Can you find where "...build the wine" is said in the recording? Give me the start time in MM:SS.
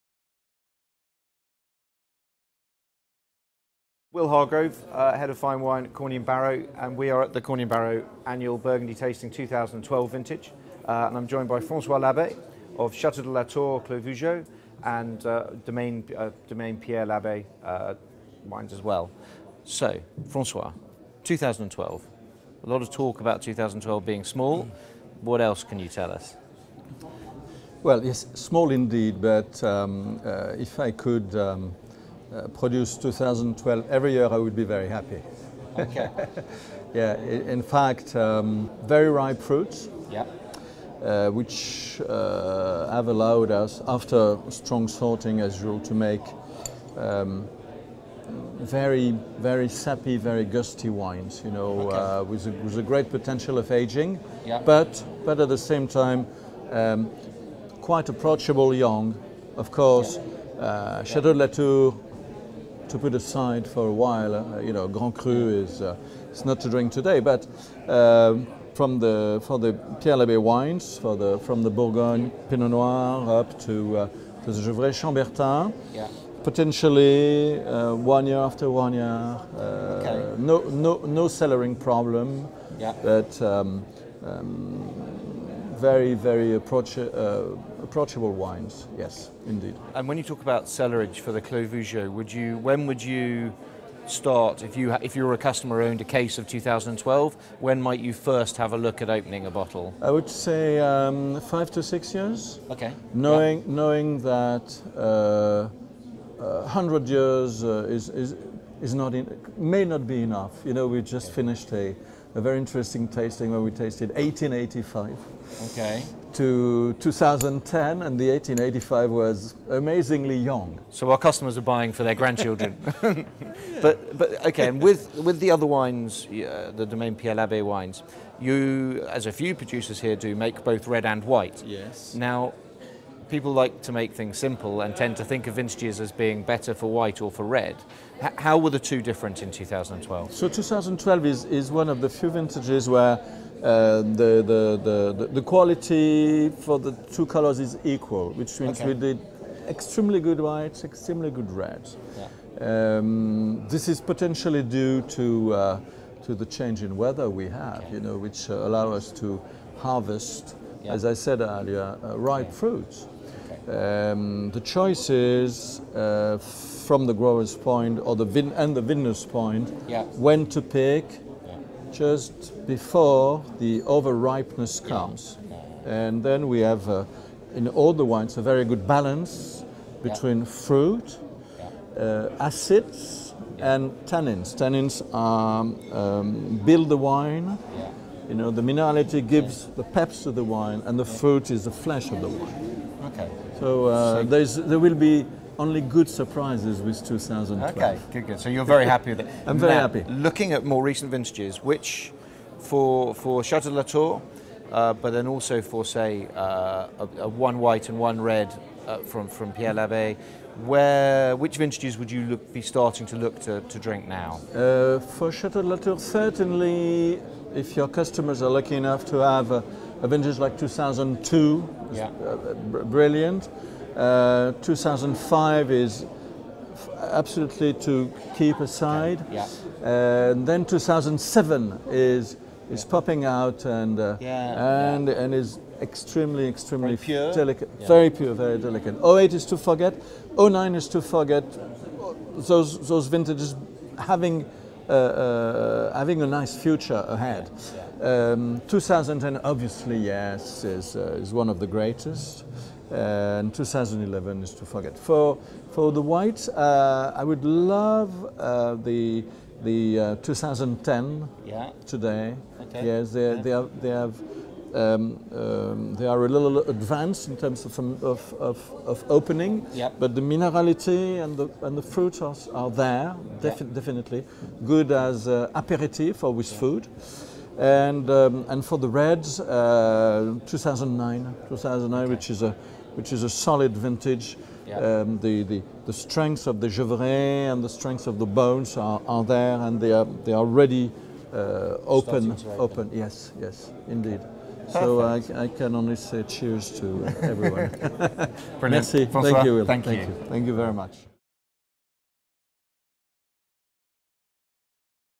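03:06.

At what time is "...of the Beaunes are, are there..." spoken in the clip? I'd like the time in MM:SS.
04:48.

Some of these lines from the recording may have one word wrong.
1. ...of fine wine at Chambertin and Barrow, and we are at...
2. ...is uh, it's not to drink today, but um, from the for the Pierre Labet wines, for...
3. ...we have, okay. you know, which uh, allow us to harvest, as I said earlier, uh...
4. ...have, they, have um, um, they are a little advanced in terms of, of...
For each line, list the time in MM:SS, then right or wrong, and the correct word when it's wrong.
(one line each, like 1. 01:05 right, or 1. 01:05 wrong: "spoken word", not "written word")
1. 00:05 wrong: "Corney", not "Chambertin"
2. 01:05 right
3. 02:37 right
4. 04:23 right.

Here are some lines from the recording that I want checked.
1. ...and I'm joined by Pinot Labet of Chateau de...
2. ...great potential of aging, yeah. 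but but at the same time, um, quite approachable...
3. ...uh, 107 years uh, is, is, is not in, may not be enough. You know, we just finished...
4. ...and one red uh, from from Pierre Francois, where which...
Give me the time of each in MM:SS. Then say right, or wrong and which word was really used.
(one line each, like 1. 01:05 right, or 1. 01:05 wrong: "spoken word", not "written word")
1. 00:11 wrong: "Francois", not "Pinot"
2. 00:52 right
3. 01:46 wrong: "100", not "107"
4. 03:27 wrong: "Labet", not "Francois".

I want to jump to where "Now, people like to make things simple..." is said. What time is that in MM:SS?
02:12.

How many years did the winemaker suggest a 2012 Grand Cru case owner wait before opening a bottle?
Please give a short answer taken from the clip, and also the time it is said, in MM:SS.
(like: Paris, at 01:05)
5 to 6 years, at 01:41.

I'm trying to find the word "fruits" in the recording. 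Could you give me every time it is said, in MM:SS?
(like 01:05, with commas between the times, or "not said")
00:39, 02:42, 03:00, 03:11, 04:31.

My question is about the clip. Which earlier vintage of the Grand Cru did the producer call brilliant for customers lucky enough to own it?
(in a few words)
2002.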